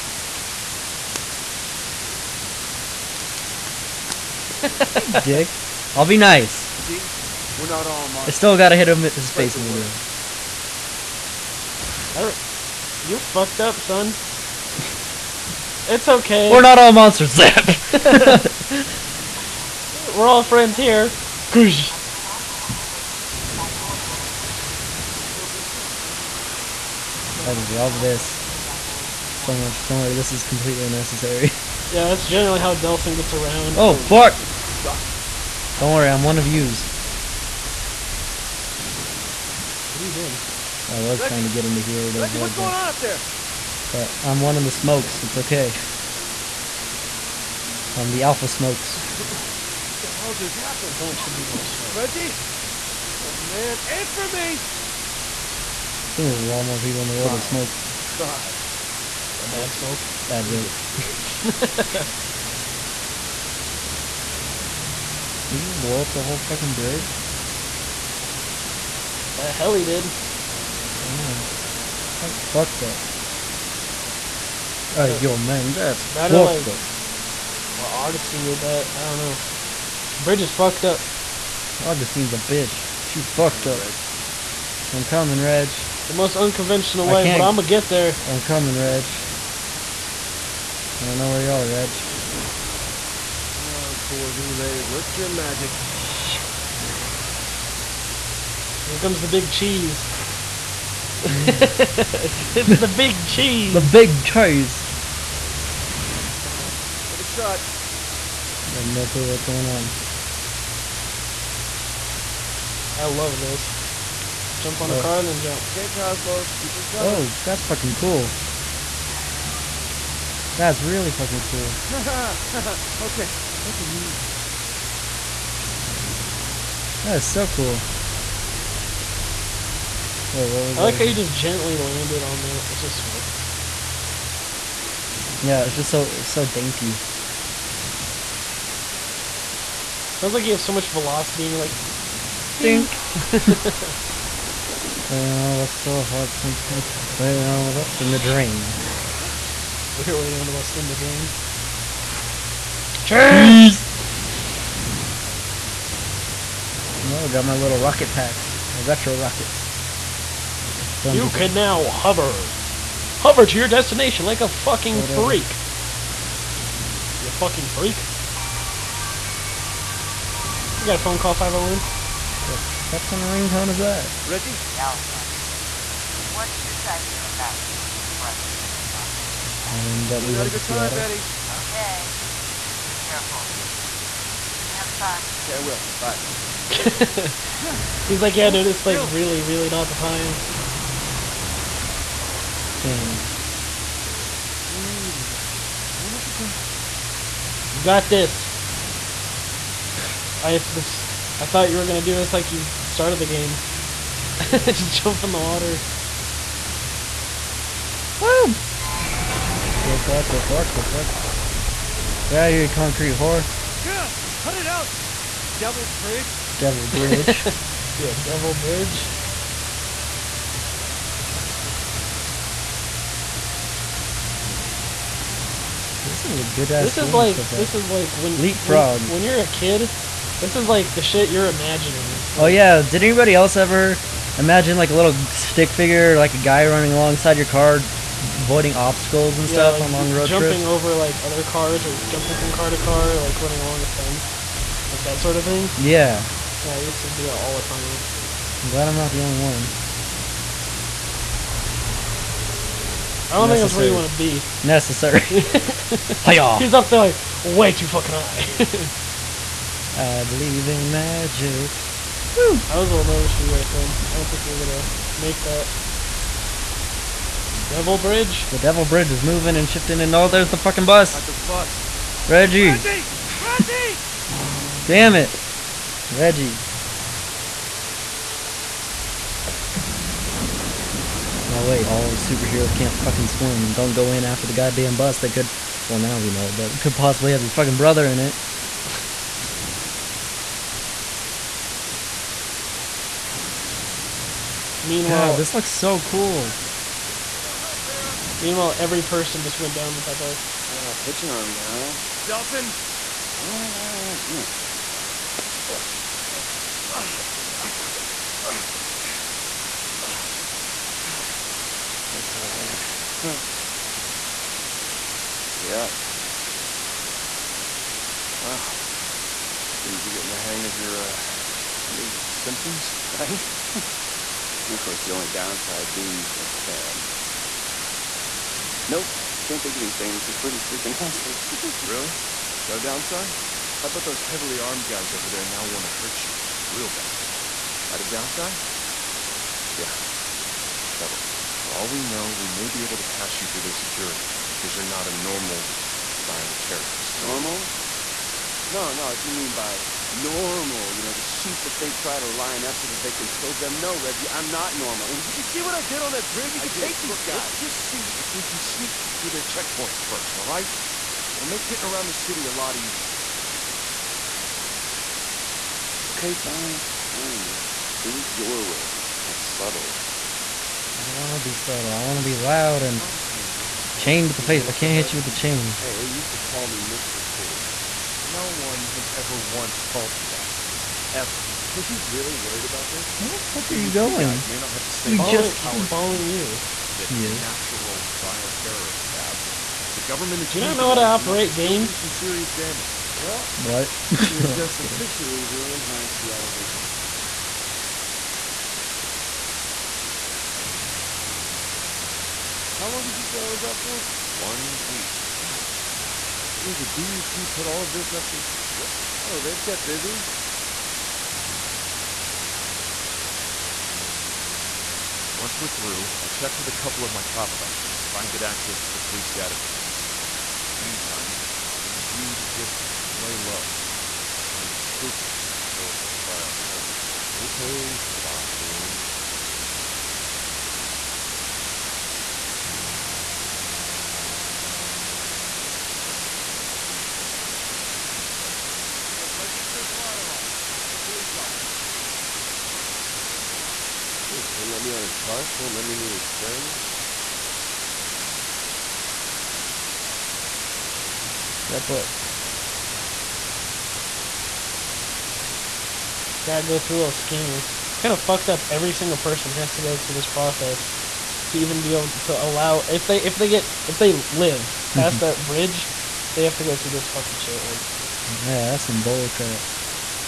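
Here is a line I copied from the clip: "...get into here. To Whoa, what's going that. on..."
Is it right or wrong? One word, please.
wrong.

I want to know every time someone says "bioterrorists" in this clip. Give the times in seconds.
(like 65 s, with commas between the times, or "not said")
388 s, 426 s.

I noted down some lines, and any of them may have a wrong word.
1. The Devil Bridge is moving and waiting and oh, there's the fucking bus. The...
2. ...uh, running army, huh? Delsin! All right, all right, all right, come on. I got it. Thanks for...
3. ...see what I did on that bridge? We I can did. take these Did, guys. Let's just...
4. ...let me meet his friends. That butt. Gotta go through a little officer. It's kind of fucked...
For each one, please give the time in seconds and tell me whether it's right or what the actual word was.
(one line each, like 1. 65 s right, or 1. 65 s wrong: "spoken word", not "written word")
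1. 268 s wrong: "shifting", not "waiting"
2. 300 s wrong: "pitching", not "running"
3. 355 s wrong: "Look", not "Did"
4. 445 s wrong: "scanner", not "officer".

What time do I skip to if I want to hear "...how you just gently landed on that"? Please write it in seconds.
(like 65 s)
130 s.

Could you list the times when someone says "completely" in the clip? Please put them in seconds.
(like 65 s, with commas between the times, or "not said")
30 s.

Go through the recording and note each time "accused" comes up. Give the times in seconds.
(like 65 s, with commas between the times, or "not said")
390 s.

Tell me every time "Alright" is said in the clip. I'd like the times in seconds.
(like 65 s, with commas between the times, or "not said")
12 s, 74 s.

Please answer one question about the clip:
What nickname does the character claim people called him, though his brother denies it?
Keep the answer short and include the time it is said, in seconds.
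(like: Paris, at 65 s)
Mr. Cool, at 376 s.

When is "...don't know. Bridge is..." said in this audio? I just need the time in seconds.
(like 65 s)
79 s.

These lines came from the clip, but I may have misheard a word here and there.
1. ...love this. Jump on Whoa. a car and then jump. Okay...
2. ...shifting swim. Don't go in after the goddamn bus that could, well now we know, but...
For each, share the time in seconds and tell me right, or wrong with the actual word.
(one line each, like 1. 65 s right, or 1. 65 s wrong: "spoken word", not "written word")
1. 113 s right
2. 282 s wrong: "fucking", not "shifting".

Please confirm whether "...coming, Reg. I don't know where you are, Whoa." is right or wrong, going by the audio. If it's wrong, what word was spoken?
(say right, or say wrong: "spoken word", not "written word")
wrong: "Reg", not "Whoa".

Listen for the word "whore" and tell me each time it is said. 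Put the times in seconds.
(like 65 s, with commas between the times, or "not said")
213 s.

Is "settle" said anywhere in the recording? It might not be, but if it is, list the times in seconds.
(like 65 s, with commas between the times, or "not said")
369 s.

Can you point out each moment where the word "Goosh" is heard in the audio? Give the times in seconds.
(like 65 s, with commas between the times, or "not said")
21 s.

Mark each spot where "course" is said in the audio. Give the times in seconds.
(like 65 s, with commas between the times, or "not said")
324 s, 442 s.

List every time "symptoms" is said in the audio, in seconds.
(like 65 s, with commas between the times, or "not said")
322 s.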